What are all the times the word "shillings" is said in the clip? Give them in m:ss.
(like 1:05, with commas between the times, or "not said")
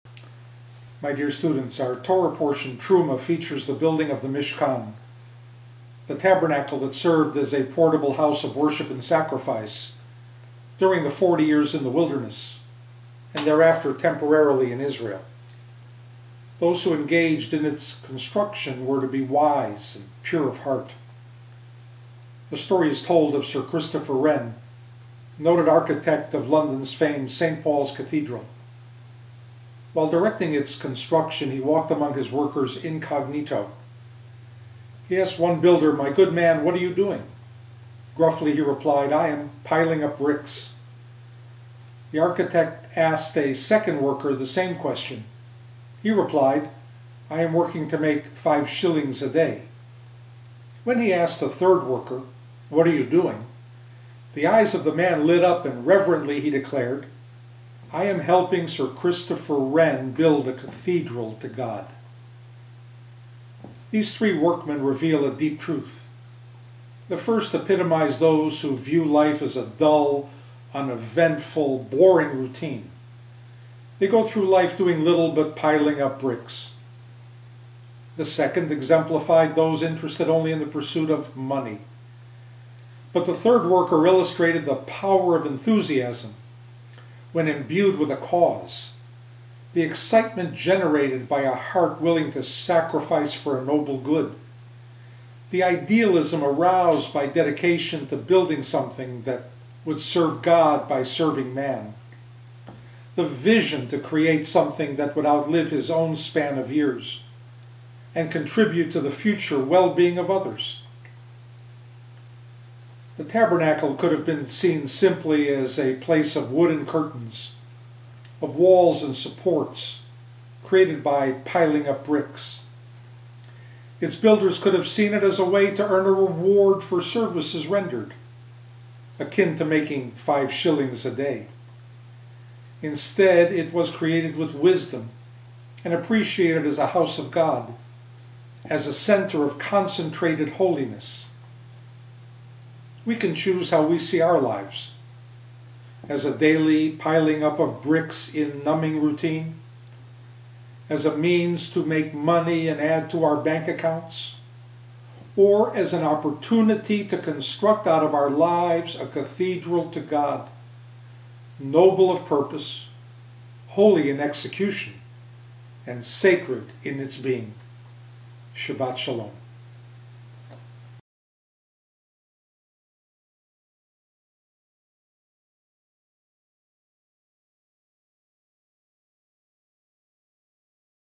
0:48, 2:10.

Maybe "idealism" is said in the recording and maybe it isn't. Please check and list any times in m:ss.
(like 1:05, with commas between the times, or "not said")
1:35.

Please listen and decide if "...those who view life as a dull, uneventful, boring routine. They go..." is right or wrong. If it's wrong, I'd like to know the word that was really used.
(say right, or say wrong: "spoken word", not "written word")
right.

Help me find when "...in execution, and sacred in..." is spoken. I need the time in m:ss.
2:44.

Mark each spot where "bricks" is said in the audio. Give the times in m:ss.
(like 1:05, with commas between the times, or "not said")
0:40, 1:16, 2:02, 2:27.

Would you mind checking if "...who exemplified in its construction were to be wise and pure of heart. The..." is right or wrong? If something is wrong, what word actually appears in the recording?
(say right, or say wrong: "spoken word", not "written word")
wrong: "engaged", not "exemplified".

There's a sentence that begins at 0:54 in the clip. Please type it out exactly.
the eyes of the man lit up and reverently he declared, I am helping Sir Christopher Wren build a cathedral to God.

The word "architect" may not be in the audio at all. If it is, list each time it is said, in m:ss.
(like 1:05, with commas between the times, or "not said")
0:25, 0:42.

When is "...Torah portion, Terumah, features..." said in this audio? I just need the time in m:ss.
0:01.